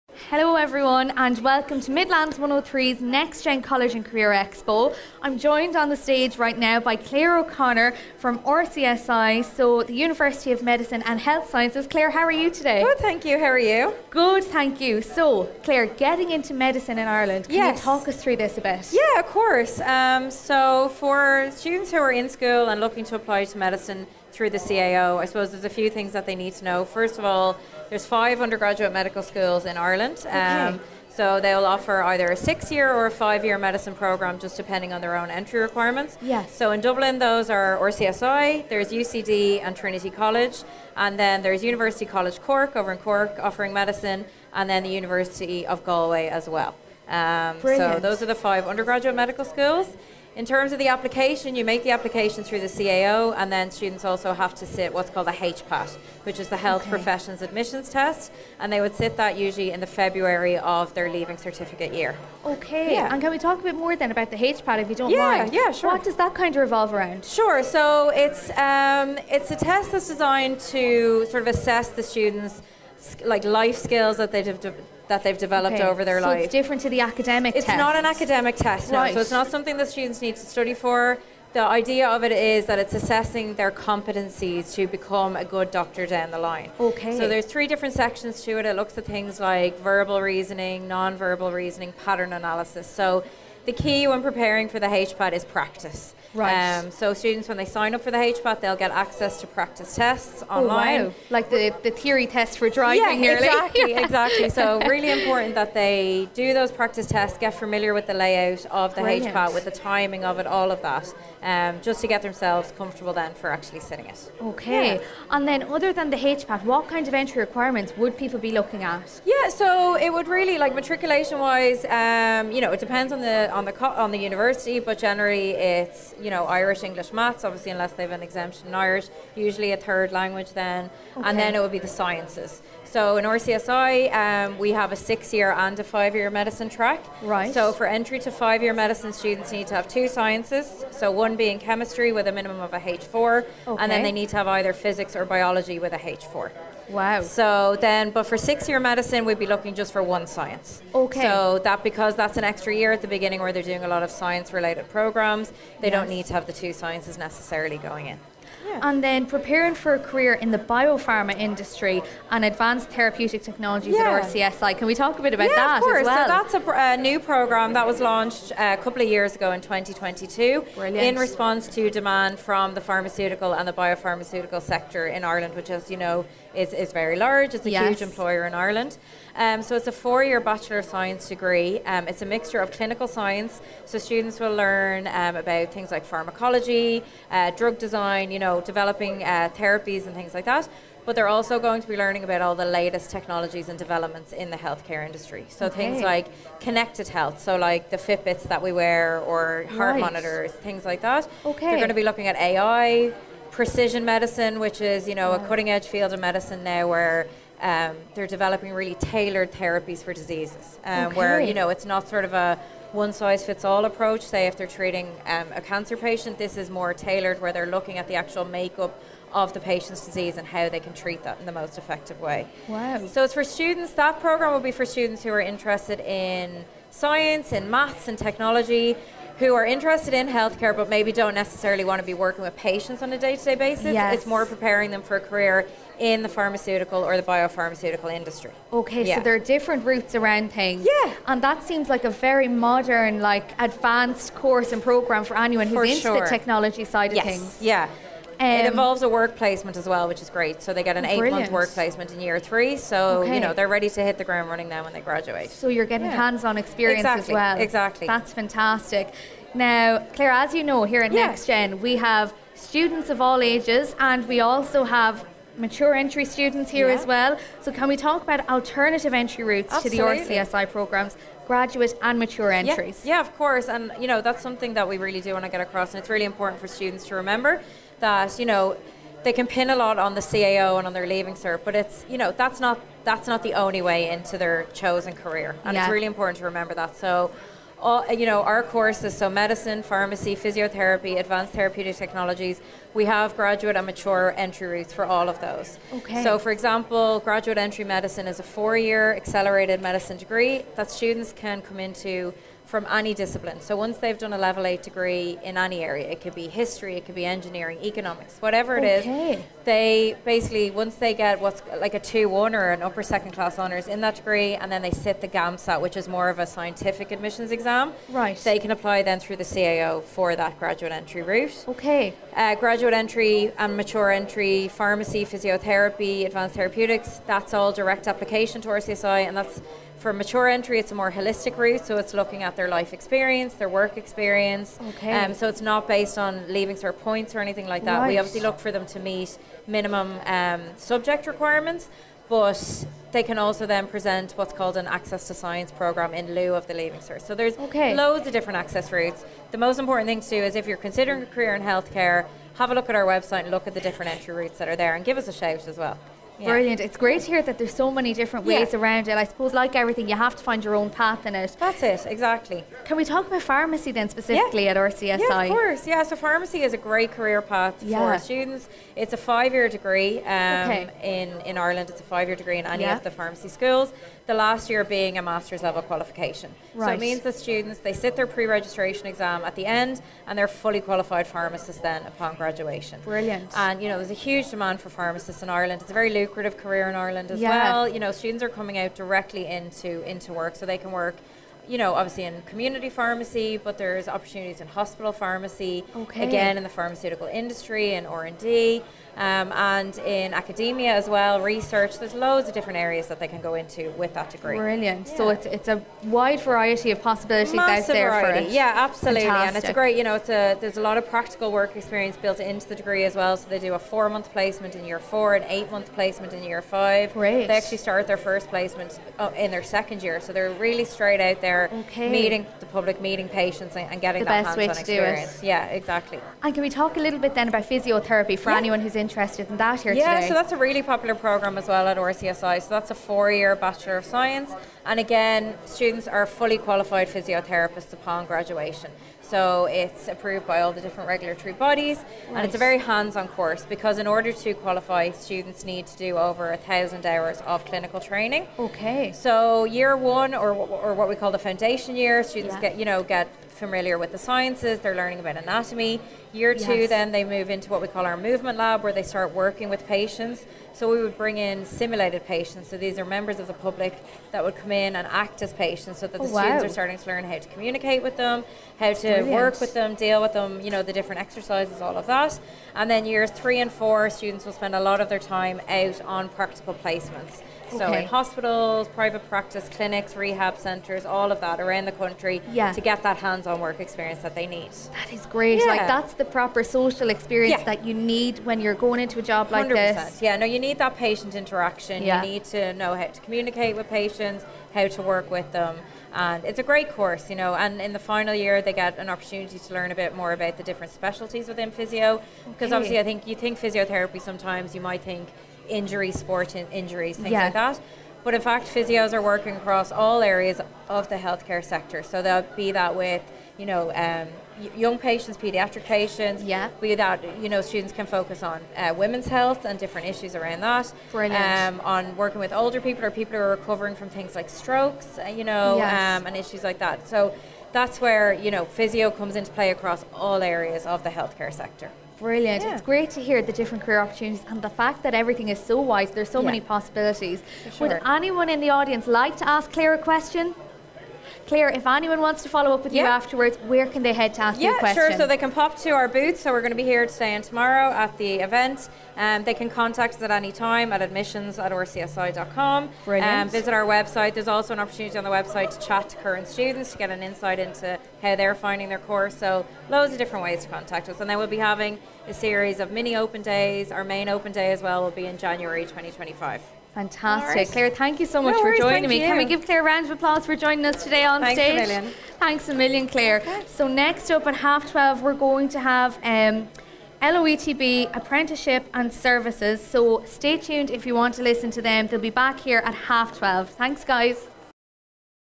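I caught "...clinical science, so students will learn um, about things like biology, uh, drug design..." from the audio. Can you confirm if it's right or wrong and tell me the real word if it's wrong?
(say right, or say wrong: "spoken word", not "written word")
wrong: "pharmacology", not "biology".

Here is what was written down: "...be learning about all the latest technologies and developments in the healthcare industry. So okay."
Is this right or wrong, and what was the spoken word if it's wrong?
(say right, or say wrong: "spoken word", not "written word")
right.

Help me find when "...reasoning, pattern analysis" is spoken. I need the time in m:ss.
1:31.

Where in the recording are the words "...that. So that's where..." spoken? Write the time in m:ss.
8:46.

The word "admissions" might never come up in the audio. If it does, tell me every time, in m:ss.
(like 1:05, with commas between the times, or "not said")
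0:57, 5:17, 9:11.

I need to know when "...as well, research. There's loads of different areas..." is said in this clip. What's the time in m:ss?
6:40.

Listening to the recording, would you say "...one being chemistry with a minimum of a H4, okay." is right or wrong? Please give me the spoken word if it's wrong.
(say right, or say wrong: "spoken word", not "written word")
right.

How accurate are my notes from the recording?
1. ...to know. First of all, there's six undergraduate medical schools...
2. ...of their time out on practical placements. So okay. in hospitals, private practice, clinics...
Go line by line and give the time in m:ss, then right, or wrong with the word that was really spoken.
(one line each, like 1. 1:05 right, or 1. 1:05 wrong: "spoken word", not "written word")
1. 0:26 wrong: "five", not "six"
2. 7:55 right.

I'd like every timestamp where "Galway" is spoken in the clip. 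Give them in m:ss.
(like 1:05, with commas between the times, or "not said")
0:45.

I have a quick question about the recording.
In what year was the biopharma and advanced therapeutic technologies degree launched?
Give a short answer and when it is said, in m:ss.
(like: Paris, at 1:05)
2022, at 2:49.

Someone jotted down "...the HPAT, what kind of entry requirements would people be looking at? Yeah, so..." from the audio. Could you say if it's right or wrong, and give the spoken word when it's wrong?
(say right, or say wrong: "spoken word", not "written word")
right.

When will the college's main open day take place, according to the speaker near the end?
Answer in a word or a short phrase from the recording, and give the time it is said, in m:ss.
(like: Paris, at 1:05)
January 2025, at 9:25.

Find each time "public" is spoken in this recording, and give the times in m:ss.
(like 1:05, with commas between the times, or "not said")
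7:02, 7:43.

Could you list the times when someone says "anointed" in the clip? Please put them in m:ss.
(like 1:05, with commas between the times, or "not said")
not said.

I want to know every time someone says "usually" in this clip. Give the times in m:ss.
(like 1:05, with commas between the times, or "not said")
0:59, 2:09.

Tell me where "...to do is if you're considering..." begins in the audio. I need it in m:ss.
5:50.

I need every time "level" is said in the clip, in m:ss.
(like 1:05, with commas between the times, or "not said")
5:04, 6:15.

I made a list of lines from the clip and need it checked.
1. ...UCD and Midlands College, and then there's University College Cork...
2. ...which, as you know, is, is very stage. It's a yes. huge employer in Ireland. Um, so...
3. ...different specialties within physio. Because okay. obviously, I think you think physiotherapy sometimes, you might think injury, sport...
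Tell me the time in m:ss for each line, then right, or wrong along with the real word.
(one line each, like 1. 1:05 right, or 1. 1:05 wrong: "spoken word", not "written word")
1. 0:38 wrong: "Trinity", not "Midlands"
2. 2:55 wrong: "large", not "stage"
3. 8:20 right.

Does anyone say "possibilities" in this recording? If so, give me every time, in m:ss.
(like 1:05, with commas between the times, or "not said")
6:47, 8:56.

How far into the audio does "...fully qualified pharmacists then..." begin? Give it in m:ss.
6:20.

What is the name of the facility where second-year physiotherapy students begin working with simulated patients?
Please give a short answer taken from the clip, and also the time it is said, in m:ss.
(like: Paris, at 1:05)
Movement lab, at 7:38.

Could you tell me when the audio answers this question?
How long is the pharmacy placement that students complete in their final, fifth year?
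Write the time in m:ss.
6:55.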